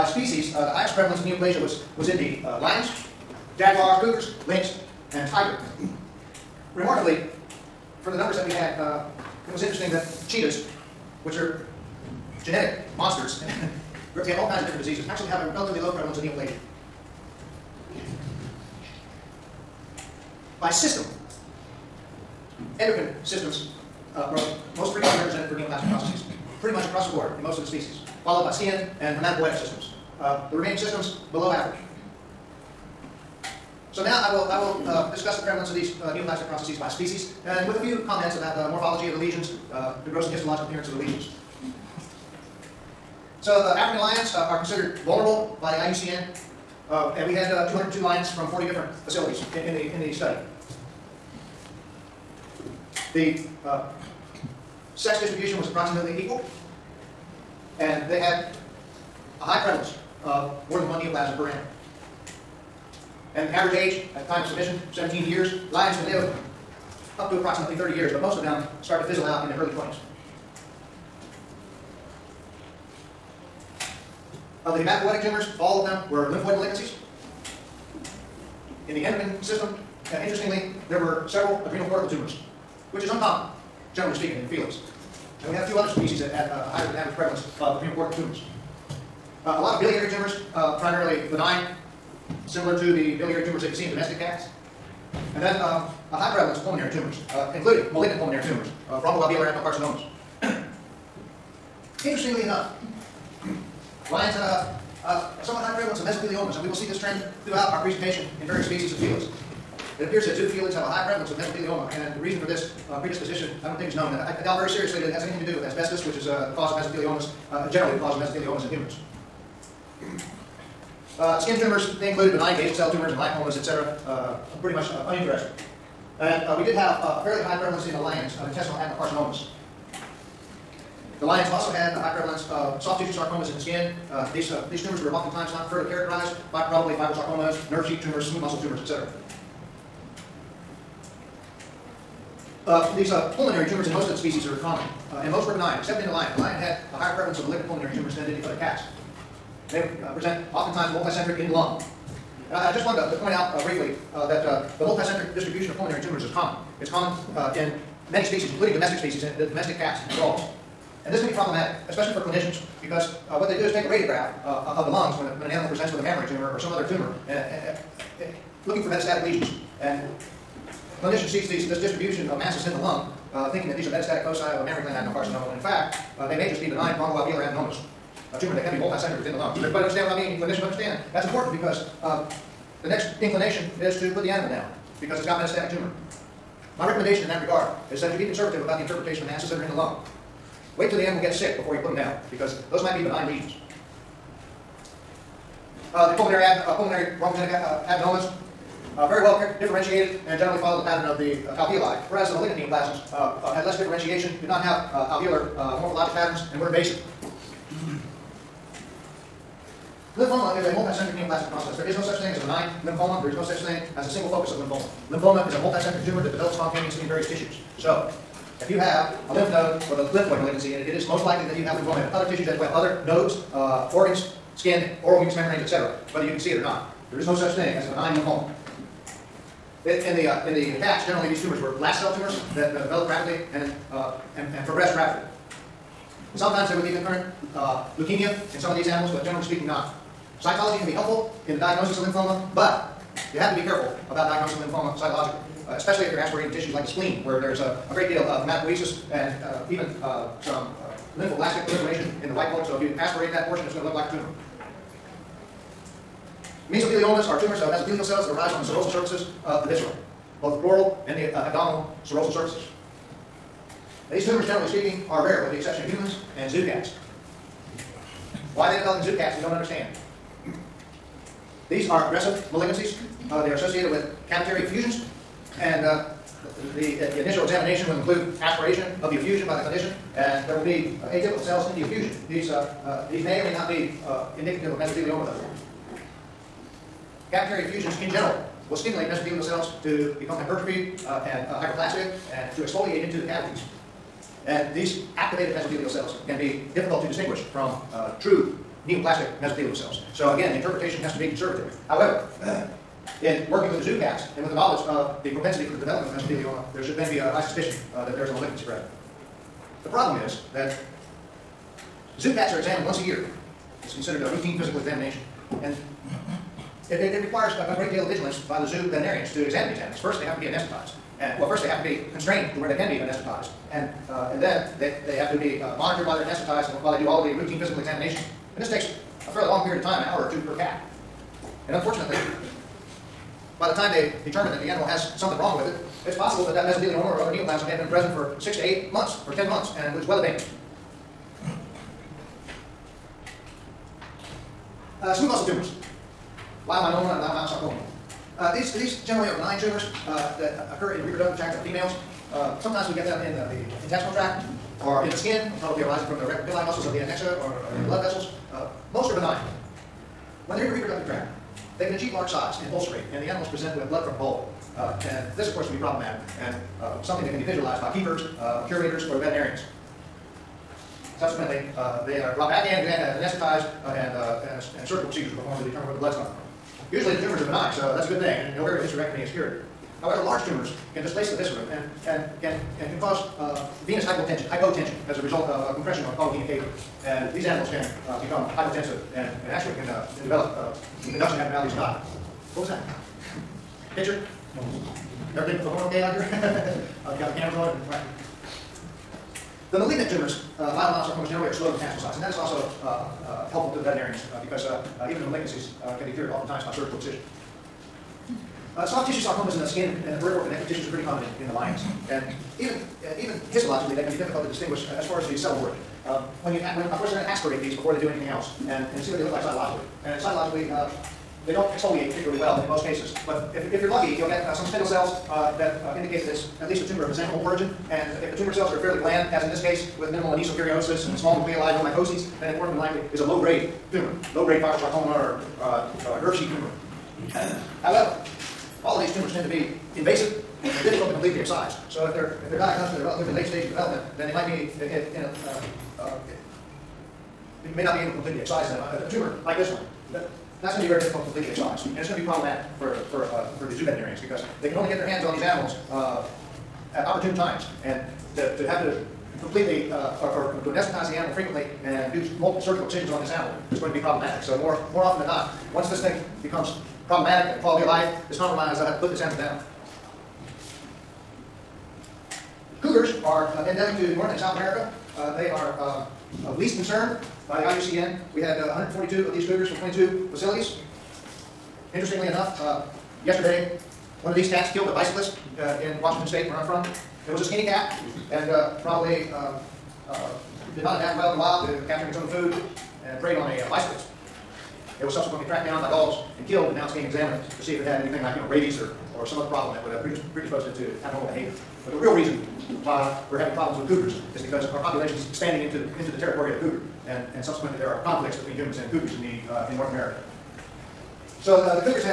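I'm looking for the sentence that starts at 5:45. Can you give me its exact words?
Uh, smooth muscle tumors, leiomyoma and leiomyosarcoma.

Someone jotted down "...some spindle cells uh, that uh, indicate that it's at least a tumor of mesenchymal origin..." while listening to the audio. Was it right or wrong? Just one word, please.
right.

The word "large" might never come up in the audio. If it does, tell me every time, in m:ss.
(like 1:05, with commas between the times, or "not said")
6:02, 6:20.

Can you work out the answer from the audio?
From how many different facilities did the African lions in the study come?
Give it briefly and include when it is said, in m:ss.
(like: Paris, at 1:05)
40, at 0:48.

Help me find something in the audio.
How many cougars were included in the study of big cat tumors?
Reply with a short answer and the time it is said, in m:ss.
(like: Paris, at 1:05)
142, at 7:58.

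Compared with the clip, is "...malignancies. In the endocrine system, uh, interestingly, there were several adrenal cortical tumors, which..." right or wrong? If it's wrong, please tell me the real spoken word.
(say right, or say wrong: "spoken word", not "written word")
right.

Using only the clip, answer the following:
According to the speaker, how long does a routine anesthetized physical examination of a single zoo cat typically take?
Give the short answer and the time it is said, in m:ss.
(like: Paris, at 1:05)
An hour or two, at 5:30.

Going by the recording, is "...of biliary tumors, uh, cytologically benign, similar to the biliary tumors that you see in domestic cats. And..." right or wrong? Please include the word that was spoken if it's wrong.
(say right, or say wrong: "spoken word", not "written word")
wrong: "primarily", not "cytologically".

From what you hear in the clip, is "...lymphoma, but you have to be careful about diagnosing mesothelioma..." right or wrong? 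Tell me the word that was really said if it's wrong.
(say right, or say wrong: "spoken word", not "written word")
wrong: "lymphoma", not "mesothelioma".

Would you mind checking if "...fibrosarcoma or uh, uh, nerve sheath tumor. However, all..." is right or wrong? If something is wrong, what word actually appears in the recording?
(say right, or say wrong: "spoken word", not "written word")
right.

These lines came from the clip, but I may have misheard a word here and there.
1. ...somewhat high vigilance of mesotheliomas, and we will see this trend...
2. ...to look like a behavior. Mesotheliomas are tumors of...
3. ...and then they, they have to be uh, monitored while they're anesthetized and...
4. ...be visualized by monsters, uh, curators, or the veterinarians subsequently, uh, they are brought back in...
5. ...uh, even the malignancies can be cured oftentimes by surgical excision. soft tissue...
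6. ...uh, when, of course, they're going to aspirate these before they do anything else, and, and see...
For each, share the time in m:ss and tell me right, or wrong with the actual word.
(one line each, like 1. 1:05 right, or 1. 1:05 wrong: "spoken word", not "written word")
1. 1:45 wrong: "prevalence", not "vigilance"
2. 4:13 wrong: "tumor", not "behavior"
3. 5:24 right
4. 6:07 wrong: "keepers", not "monsters"
5. 6:45 right
6. 6:56 right.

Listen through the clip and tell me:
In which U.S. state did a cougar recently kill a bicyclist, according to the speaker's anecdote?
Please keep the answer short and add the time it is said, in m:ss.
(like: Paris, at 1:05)
Washington State, at 8:06.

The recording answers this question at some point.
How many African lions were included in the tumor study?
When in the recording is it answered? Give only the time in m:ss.
0:47.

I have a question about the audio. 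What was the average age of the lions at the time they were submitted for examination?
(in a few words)
17 years.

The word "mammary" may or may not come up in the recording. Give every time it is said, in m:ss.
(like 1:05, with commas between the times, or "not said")
2:46, 2:54.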